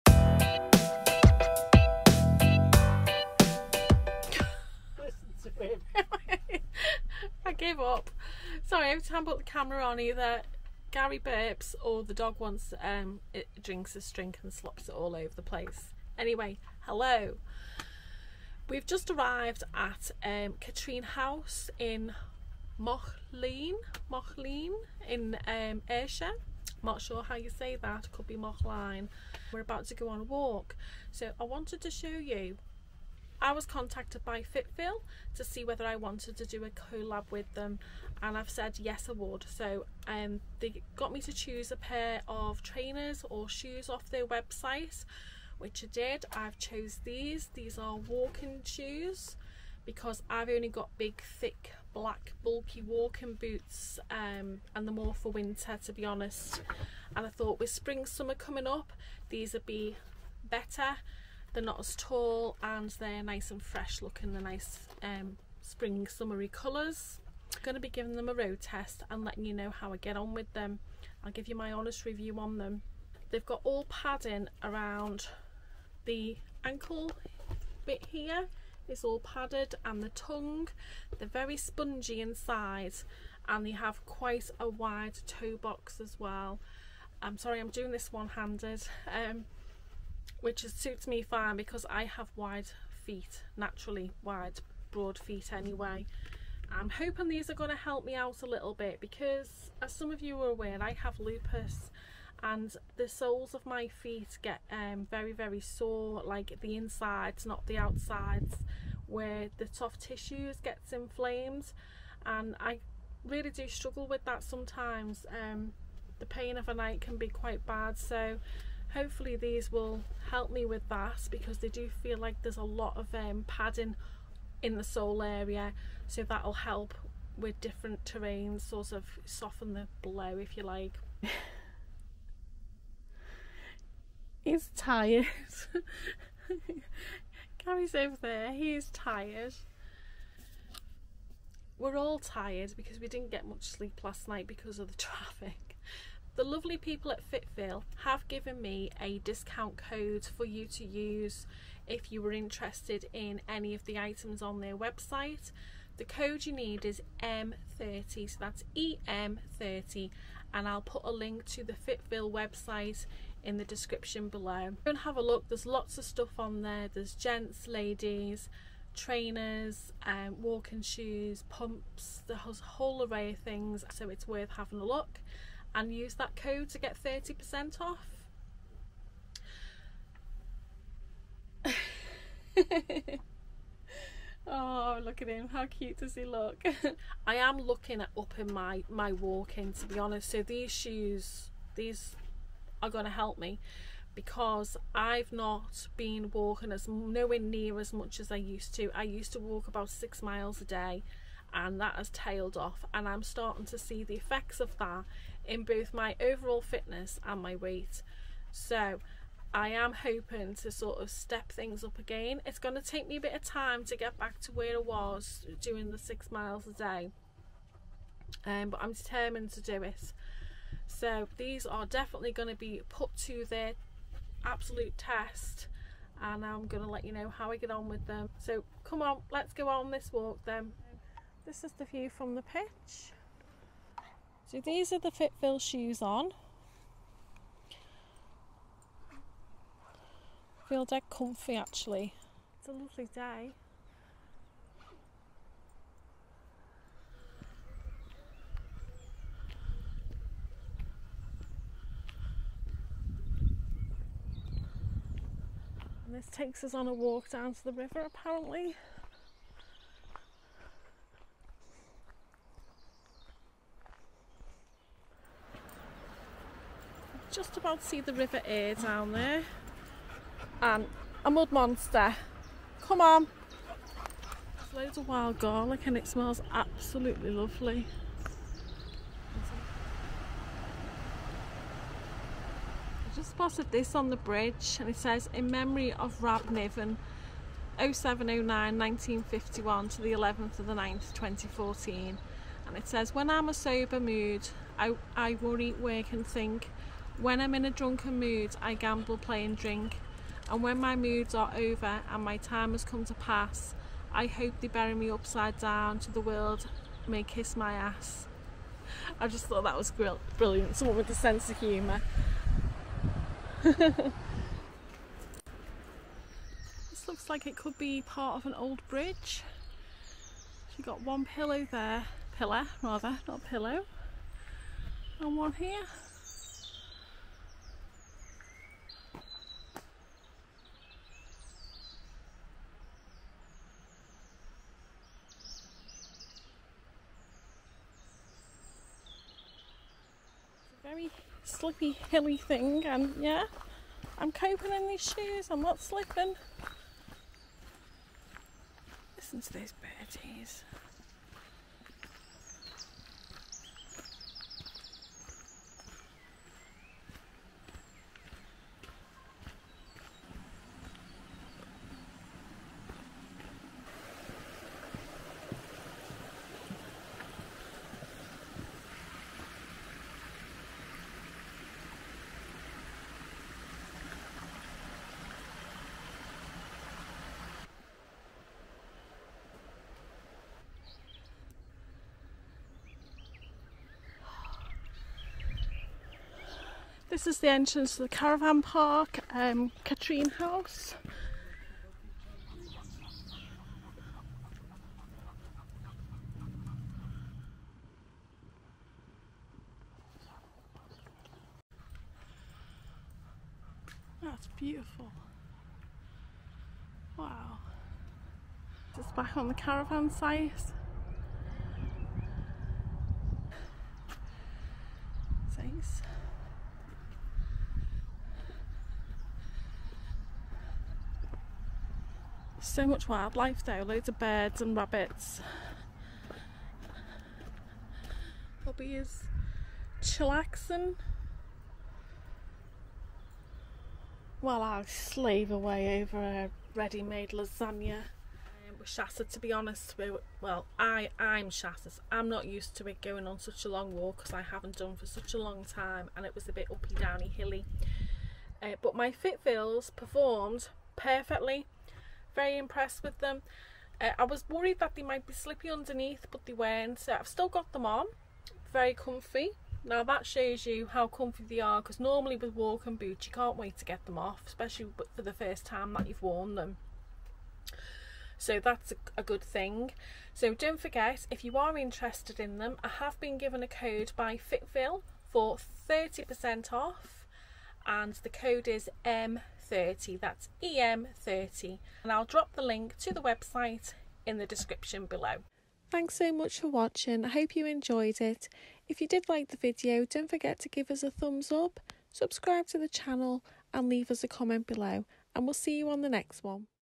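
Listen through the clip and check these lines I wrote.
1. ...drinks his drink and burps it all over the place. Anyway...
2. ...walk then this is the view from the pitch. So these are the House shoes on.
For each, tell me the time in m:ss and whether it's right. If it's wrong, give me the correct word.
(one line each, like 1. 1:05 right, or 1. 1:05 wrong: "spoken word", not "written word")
1. 0:13 wrong: "slops", not "burps"
2. 3:50 wrong: "Fitville", not "House".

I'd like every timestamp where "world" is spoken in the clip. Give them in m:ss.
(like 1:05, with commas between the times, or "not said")
5:06.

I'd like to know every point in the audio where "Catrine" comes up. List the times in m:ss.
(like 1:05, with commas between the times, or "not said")
0:20, 6:29.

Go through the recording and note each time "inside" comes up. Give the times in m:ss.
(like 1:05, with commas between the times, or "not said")
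1:22, 1:46.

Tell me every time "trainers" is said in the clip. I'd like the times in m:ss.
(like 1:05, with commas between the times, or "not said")
0:42, 2:48.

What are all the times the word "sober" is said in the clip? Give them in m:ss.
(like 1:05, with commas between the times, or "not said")
4:53.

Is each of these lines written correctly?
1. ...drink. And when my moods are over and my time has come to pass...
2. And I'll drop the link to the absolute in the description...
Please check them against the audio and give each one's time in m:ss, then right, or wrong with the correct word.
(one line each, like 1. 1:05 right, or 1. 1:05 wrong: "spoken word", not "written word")
1. 4:59 right
2. 8:02 wrong: "website", not "absolute".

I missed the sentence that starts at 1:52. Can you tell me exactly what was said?
And I really do struggle with that sometimes.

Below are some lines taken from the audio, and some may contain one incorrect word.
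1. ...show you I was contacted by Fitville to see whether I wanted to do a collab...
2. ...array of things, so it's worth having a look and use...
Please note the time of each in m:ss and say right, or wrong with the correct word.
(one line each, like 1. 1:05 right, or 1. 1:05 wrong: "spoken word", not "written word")
1. 0:31 right
2. 2:53 right.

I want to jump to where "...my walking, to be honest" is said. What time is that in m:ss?
3:08.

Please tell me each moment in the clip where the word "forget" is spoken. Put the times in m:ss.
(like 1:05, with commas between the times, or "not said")
7:50, 8:10.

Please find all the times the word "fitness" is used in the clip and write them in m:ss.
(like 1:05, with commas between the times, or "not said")
3:26.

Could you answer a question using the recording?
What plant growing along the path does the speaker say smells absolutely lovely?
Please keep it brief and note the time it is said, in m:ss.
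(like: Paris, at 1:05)
wild garlic, at 4:35.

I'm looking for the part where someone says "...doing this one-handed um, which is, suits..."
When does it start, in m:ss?
1:27.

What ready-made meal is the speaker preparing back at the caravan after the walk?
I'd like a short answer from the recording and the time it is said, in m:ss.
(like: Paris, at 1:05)
lasagna, at 7:17.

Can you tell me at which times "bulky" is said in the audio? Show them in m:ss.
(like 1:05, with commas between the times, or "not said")
0:52.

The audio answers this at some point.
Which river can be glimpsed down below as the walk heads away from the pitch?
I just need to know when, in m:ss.
4:28.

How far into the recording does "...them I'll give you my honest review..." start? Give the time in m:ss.
1:10.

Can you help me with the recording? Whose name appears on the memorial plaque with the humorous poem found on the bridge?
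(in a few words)
Rab Niven.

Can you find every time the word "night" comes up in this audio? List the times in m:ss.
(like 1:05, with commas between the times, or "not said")
1:56, 2:24.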